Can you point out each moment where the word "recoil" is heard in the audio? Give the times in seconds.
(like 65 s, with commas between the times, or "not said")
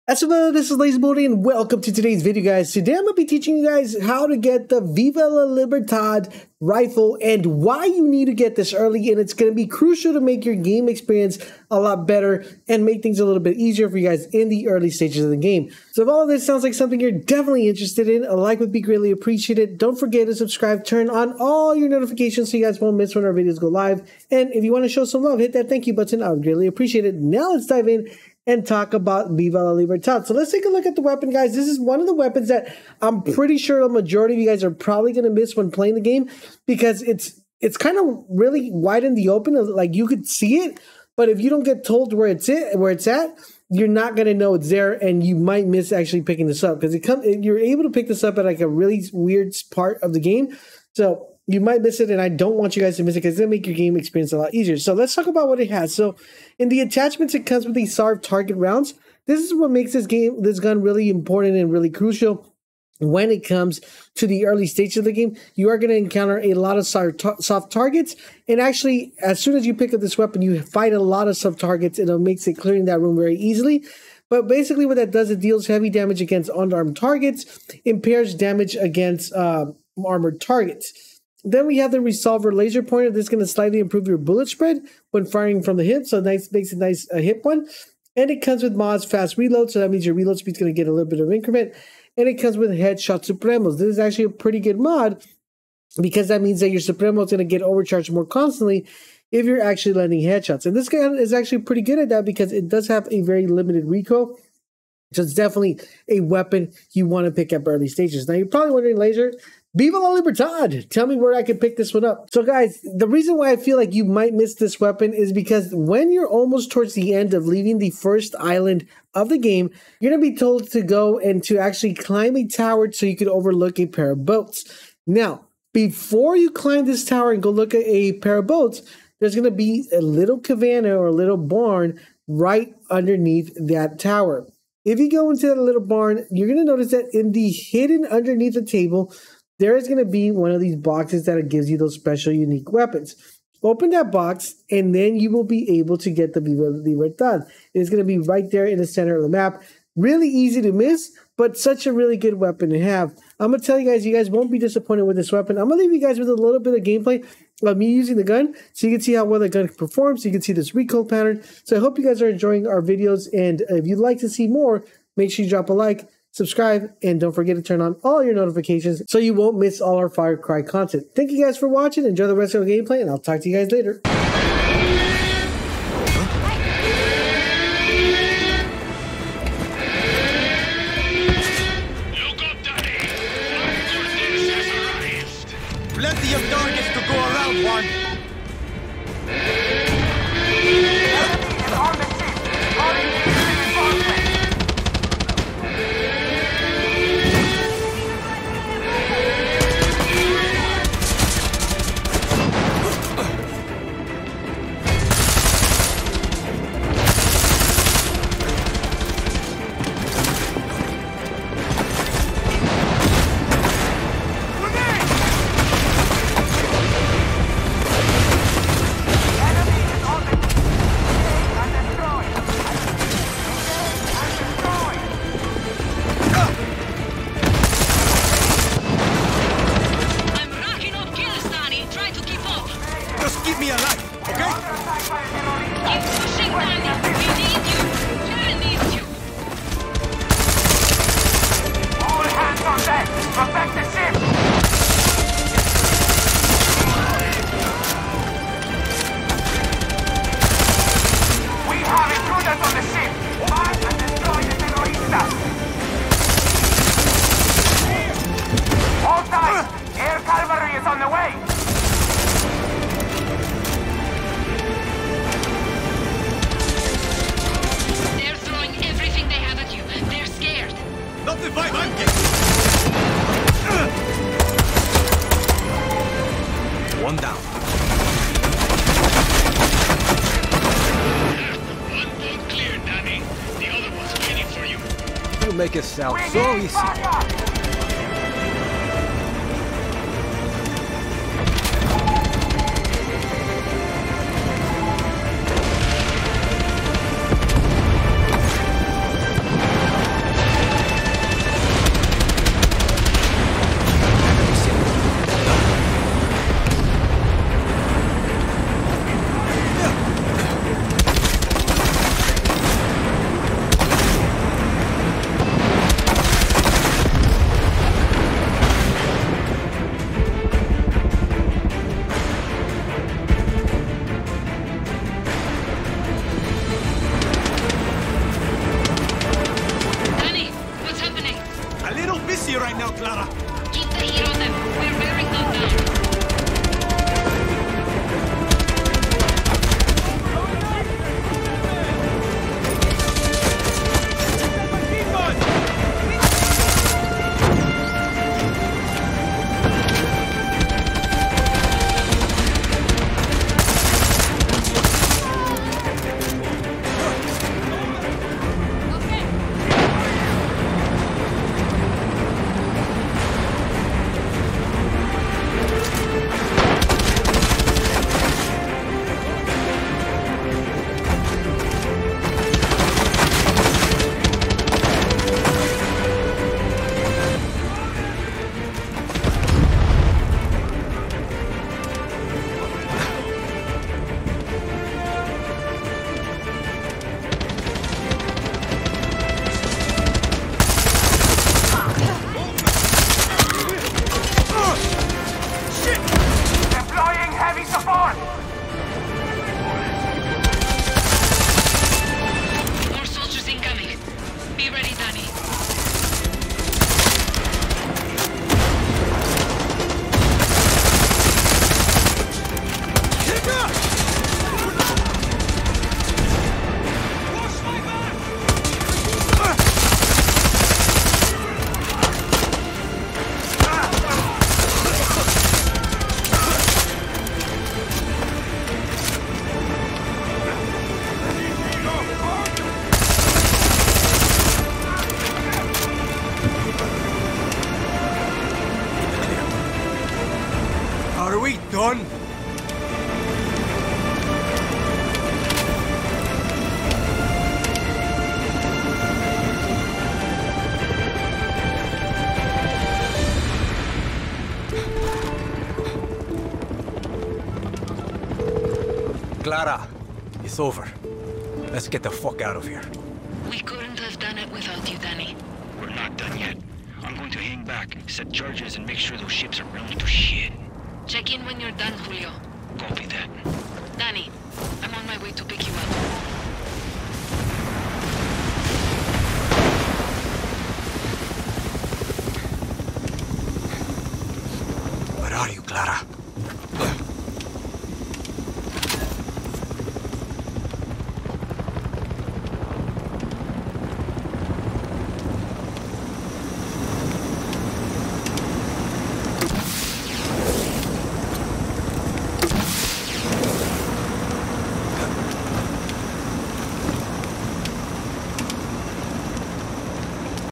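103 s, 160 s.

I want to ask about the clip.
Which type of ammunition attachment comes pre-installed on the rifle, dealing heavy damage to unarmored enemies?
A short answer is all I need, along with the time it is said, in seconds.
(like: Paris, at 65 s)
soft target rounds, at 57 s.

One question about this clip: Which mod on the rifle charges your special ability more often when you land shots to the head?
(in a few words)
headshot supremos.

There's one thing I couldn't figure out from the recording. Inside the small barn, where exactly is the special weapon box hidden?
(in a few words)
underneath the table.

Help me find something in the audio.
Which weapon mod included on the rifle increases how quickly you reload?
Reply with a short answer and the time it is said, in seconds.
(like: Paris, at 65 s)
fast reload, at 89 s.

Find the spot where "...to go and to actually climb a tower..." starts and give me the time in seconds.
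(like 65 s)
120 s.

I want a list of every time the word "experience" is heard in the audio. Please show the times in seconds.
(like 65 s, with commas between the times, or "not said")
10 s, 53 s.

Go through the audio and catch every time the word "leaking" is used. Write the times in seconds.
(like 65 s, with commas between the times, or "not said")
not said.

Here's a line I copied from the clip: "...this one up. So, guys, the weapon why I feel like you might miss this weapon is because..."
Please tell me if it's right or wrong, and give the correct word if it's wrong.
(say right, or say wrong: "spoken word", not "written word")
wrong: "reason", not "weapon".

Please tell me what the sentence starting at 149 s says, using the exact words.
Really easy to miss, but such a really good weapon to have.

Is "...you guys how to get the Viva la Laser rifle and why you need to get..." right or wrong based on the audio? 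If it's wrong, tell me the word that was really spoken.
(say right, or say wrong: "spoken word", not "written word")
wrong: "Libertad", not "Laser".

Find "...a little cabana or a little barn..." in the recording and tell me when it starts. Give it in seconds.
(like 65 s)
129 s.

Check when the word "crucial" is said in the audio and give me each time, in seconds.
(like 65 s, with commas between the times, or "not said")
9 s, 61 s.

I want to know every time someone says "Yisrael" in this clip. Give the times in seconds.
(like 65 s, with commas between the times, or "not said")
not said.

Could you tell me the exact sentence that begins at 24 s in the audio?
And if you want to show some love, hit that thank you button.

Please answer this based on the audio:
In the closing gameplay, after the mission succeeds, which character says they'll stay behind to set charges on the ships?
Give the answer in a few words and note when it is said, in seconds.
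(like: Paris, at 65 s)
Julio, at 471 s.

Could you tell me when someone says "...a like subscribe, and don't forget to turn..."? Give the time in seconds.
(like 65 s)
165 s.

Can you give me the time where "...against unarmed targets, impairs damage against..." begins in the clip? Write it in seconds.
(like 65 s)
76 s.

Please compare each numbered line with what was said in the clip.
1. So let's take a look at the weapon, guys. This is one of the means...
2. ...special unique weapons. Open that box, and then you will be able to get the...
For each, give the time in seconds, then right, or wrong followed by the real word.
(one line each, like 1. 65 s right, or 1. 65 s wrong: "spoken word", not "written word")
1. 30 s wrong: "weapons", not "means"
2. 141 s right.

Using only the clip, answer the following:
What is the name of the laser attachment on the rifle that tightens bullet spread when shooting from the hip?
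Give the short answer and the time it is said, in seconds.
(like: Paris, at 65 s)
resolver laser pointer, at 81 s.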